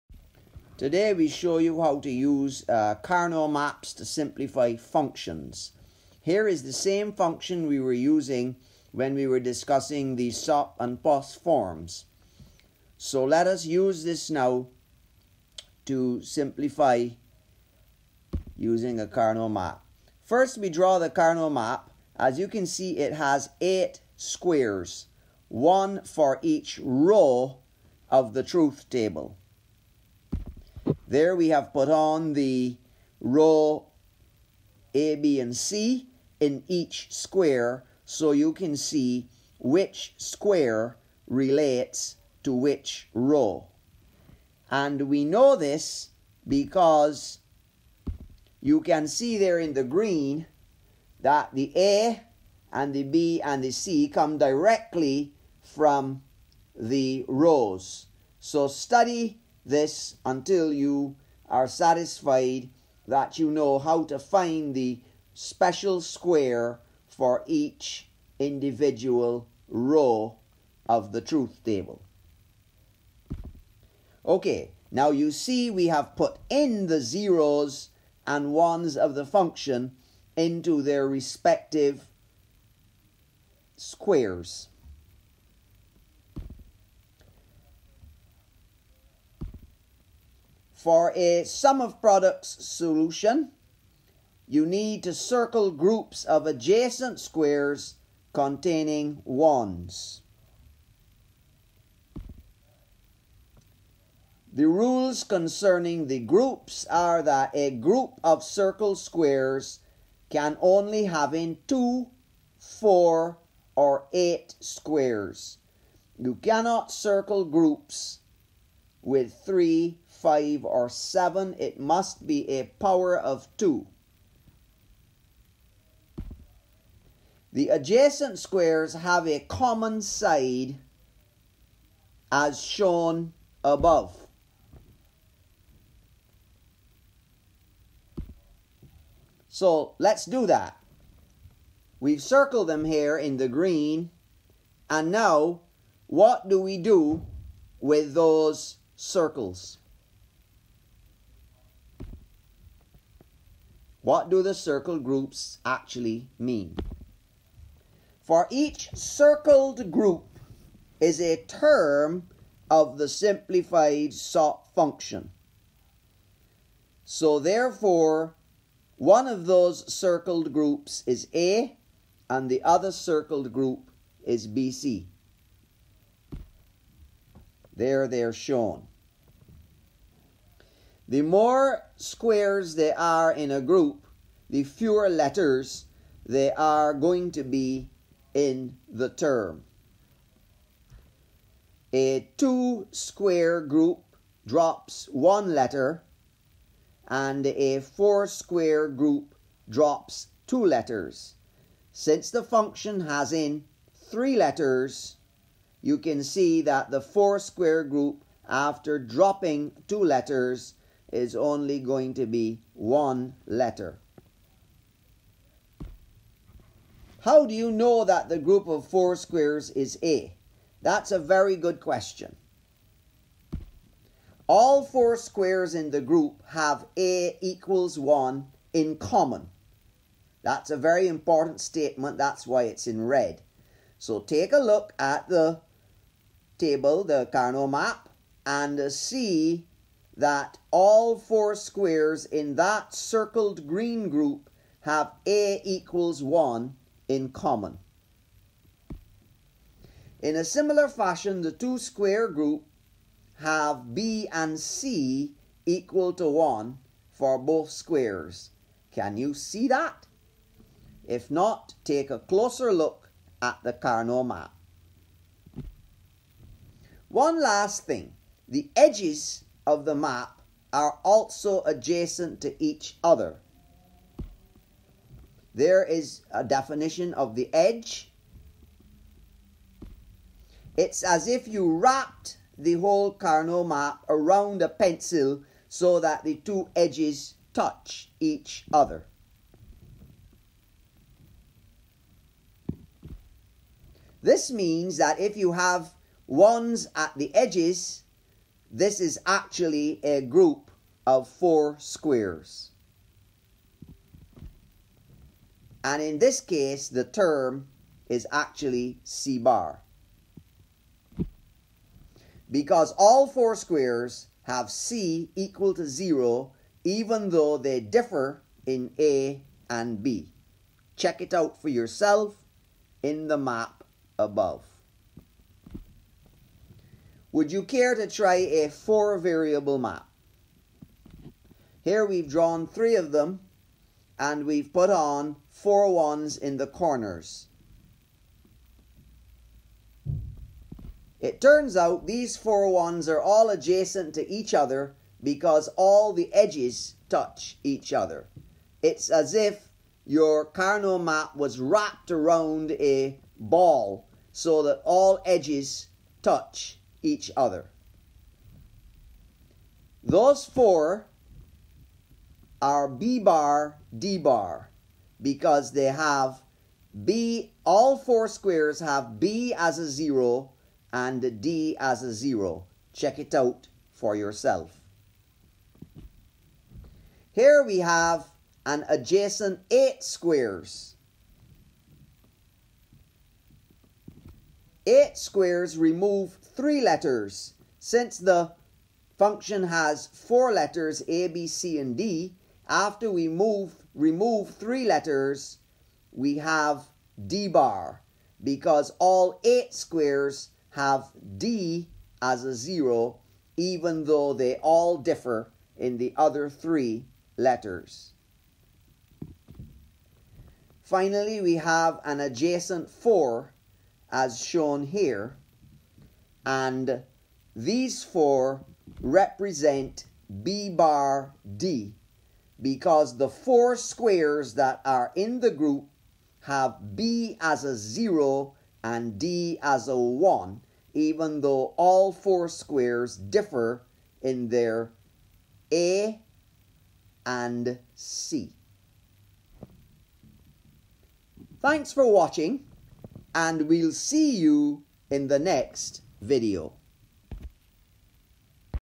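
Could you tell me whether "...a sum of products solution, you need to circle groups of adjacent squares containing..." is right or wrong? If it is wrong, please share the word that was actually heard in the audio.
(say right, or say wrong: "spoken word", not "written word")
right.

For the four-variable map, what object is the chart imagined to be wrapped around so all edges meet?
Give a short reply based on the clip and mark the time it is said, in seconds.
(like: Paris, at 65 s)
A ball, at 353 s.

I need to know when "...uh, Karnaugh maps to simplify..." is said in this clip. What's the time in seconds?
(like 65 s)
2 s.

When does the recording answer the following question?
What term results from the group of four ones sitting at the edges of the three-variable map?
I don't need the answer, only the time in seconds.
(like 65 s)
309 s.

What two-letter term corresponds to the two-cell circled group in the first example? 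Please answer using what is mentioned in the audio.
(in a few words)
BC.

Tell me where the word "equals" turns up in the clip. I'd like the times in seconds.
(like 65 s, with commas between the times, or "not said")
227 s, 245 s, 255 s, 315 s.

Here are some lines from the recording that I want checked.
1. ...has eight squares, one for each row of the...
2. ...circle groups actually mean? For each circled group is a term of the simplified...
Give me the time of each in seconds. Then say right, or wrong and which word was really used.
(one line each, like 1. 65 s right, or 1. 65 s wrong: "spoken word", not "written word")
1. 23 s right
2. 154 s right.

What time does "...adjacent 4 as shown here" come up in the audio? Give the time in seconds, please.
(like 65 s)
412 s.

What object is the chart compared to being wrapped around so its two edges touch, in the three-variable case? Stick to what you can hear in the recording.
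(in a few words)
A pencil.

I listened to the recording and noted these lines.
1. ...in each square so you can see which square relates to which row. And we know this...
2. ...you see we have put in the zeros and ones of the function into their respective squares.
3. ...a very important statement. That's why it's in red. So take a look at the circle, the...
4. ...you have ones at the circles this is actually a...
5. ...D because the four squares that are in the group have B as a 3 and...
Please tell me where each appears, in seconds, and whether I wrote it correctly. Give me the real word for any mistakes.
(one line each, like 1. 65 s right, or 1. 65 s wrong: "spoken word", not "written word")
1. 36 s right
2. 75 s right
3. 230 s wrong: "table", not "circle"
4. 295 s wrong: "edges", not "circles"
5. 421 s wrong: "0", not "3".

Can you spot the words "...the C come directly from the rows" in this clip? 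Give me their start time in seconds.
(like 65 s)
53 s.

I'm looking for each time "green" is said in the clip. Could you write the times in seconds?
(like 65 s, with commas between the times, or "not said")
49 s, 143 s, 243 s.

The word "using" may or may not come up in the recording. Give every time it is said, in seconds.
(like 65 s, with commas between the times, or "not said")
7 s, 18 s.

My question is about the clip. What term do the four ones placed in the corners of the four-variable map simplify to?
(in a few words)
B bar D bar.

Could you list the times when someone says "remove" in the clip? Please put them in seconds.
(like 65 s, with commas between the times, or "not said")
385 s, 393 s.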